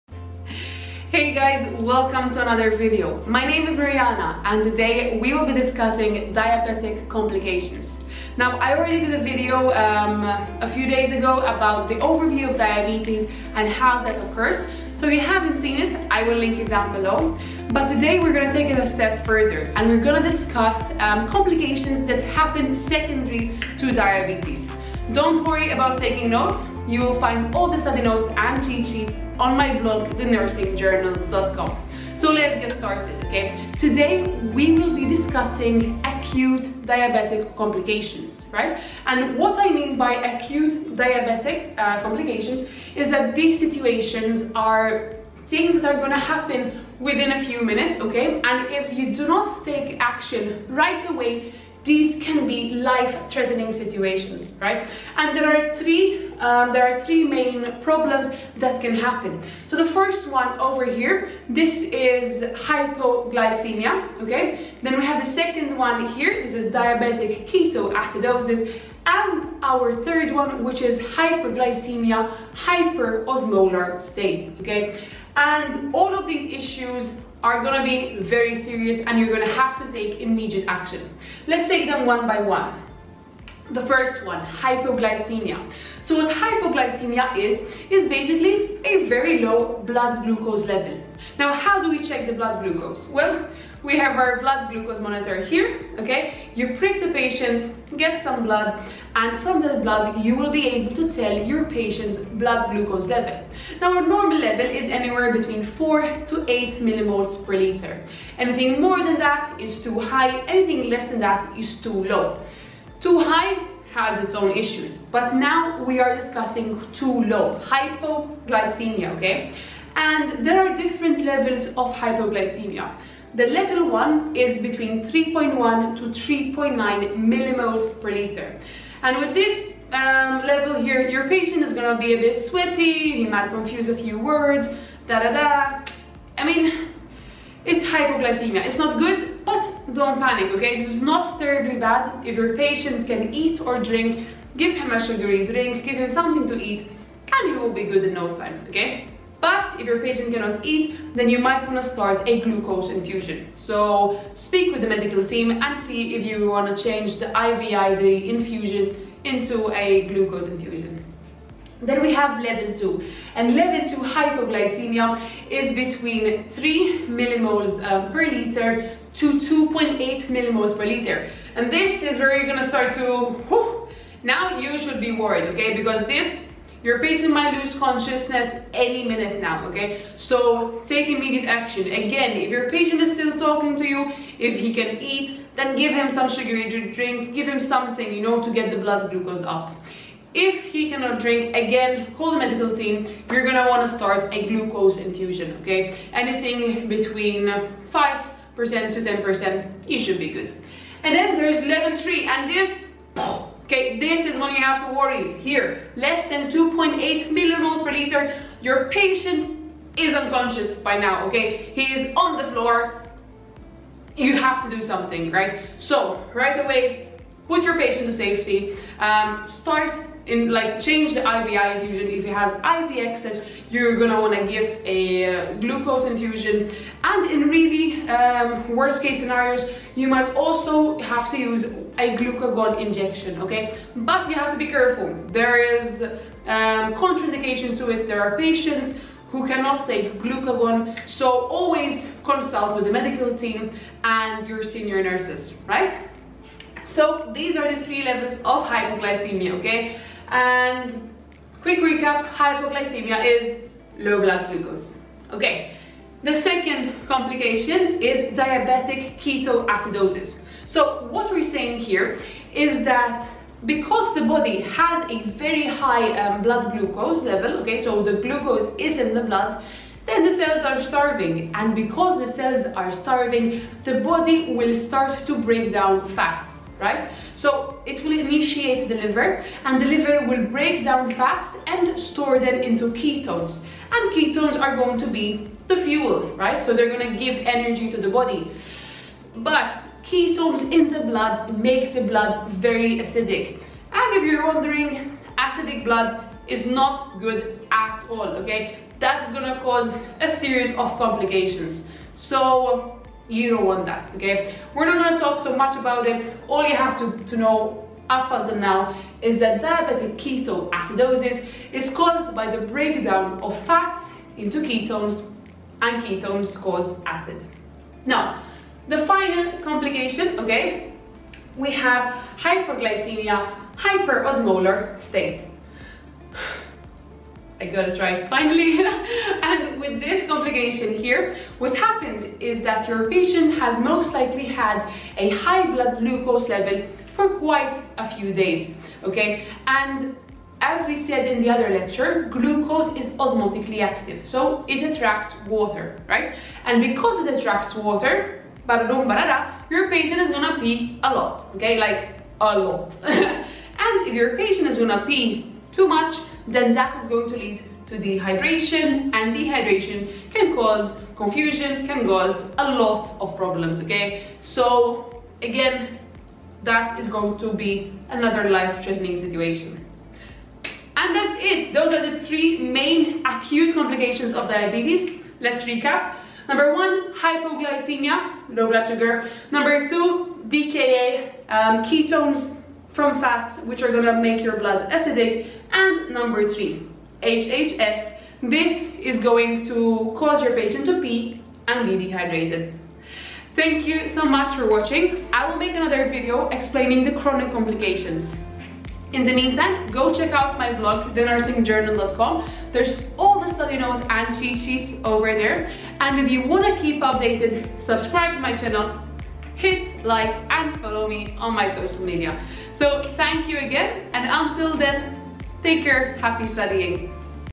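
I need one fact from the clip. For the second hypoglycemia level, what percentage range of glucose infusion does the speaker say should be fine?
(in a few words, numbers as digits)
5% to 10%.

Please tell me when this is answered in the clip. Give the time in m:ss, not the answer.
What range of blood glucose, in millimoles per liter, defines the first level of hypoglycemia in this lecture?
2:05.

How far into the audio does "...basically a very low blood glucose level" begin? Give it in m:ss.
1:28.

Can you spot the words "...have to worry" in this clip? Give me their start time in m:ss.
3:24.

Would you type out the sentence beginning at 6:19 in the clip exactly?
Number two, DKA, um, ketones, from fats, which are gonna make your blood acidic.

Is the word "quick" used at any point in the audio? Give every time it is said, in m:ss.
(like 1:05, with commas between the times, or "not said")
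4:11.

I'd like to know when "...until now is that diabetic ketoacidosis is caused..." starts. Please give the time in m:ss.
5:08.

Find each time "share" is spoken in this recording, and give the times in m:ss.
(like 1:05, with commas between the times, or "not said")
not said.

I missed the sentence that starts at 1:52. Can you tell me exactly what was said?
Too high has its own issues, but now we are discussing too low, hypoglycemia, okay?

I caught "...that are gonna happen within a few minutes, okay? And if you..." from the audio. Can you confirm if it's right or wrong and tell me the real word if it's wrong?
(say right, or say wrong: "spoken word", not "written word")
right.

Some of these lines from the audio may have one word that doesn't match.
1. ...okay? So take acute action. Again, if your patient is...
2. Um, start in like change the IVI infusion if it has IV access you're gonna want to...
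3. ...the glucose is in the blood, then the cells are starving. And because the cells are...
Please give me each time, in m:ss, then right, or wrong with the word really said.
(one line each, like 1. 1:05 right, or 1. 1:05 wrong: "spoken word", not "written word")
1. 2:59 wrong: "immediate", not "acute"
2. 3:38 right
3. 4:28 right.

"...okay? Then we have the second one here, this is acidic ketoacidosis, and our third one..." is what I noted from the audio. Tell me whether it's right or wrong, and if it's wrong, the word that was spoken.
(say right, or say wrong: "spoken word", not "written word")
wrong: "diabetic", not "acidic".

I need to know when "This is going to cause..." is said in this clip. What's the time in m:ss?
6:28.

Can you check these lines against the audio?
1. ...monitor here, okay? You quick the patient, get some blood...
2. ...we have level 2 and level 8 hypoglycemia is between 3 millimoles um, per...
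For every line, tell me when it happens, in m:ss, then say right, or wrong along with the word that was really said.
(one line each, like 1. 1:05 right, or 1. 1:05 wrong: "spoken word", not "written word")
1. 1:35 wrong: "prick", not "quick"
2. 2:42 wrong: "2", not "8".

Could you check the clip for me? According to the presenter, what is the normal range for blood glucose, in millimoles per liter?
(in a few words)
4 to 8.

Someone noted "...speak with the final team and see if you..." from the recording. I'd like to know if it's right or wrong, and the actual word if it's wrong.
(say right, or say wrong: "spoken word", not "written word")
wrong: "medical", not "final".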